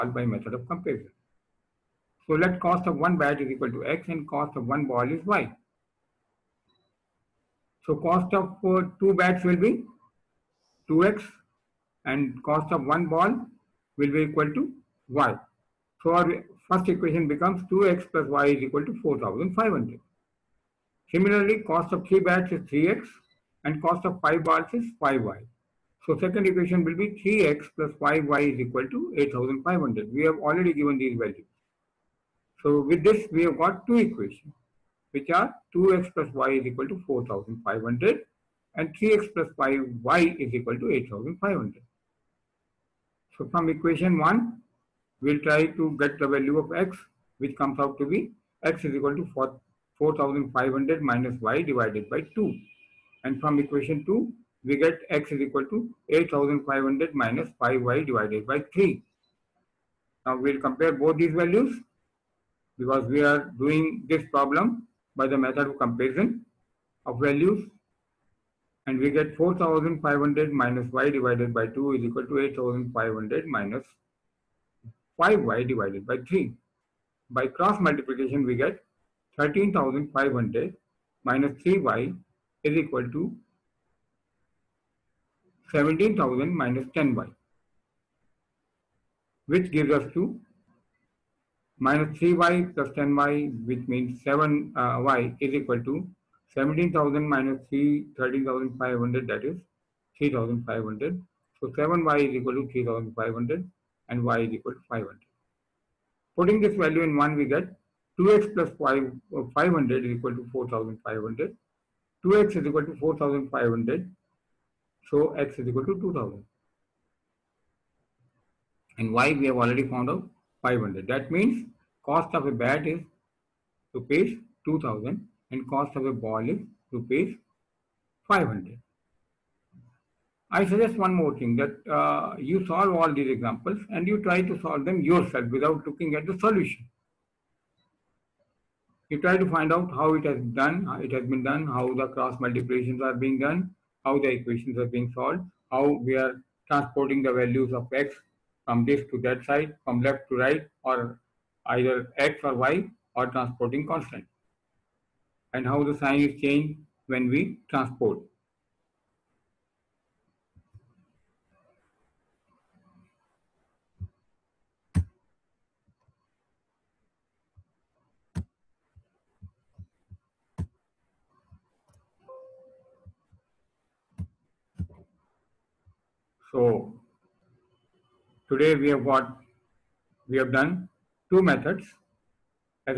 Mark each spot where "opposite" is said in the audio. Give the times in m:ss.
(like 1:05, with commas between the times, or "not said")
not said.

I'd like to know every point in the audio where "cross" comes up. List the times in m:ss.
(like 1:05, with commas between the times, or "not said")
1:17, 2:22.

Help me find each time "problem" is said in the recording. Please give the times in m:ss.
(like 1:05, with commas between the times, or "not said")
1:04.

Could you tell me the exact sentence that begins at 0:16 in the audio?
So our first equation becomes 2x plus y is equal to 4500.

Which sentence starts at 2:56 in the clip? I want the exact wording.
So today we have got, we have done two methods.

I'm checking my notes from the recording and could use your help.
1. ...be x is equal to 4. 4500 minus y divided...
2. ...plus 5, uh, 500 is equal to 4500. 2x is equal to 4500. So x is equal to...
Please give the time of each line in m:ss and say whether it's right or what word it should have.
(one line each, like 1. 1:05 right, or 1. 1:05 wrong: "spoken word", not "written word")
1. 0:48 right
2. 1:48 right.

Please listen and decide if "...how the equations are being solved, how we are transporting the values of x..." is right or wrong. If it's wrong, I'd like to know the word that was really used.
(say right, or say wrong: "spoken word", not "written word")
right.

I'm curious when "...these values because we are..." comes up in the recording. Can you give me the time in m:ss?
1:01.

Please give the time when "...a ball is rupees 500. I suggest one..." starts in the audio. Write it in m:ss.
2:06.